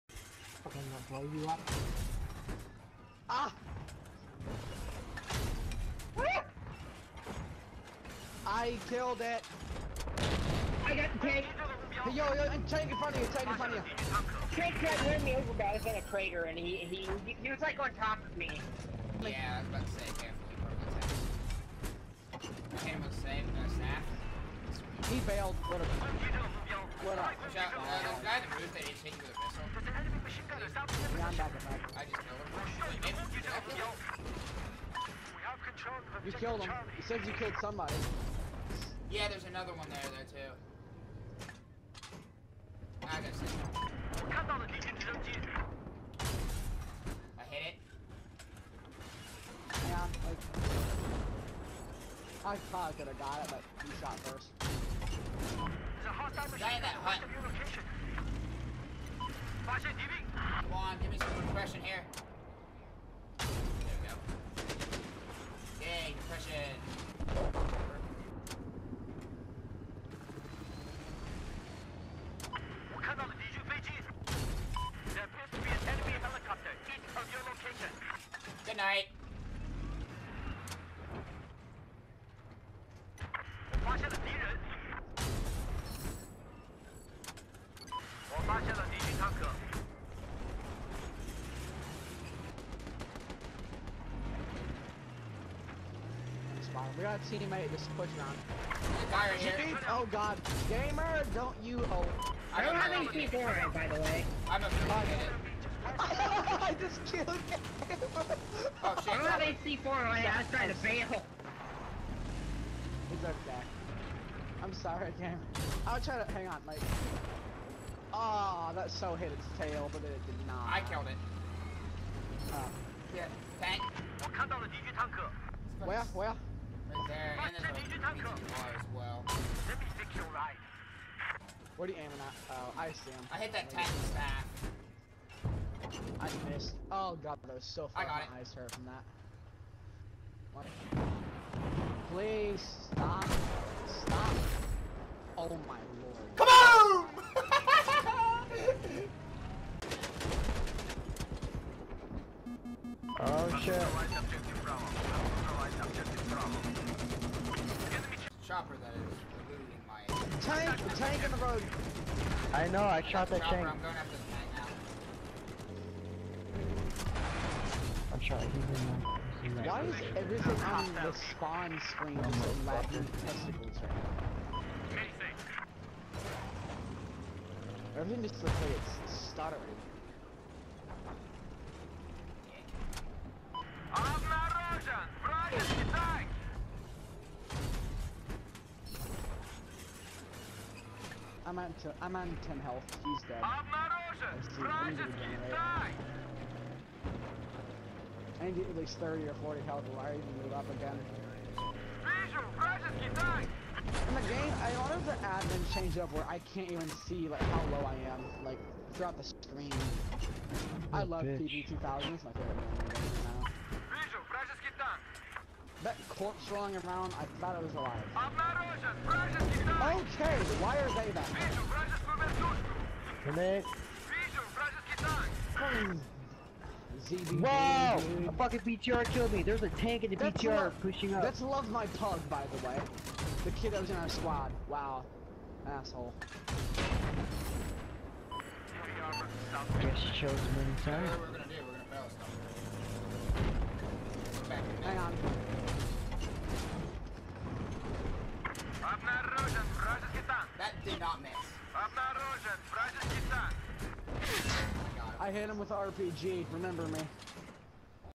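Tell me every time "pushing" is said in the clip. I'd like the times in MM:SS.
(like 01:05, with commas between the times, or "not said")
01:37, 03:50.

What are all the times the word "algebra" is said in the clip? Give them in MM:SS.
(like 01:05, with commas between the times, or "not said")
not said.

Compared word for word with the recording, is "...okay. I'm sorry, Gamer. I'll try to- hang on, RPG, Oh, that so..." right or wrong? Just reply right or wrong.
wrong.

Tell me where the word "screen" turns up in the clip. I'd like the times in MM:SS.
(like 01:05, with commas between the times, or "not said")
02:51, 03:29.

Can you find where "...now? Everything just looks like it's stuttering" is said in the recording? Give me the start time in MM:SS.
02:54.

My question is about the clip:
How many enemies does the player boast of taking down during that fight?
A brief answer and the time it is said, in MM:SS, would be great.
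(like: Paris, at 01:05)
6, at 00:43.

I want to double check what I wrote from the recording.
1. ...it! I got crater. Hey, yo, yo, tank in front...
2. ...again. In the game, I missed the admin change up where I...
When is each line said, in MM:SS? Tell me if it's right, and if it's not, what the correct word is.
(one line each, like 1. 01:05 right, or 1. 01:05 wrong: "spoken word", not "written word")
1. 00:09 right
2. 03:20 wrong: "wanted", not "missed".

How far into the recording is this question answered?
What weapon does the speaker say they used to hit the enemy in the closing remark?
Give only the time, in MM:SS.
04:15.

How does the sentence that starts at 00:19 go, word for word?
Like, yeah, I was about to say, carefully, bro.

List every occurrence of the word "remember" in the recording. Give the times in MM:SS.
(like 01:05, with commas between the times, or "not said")
04:16.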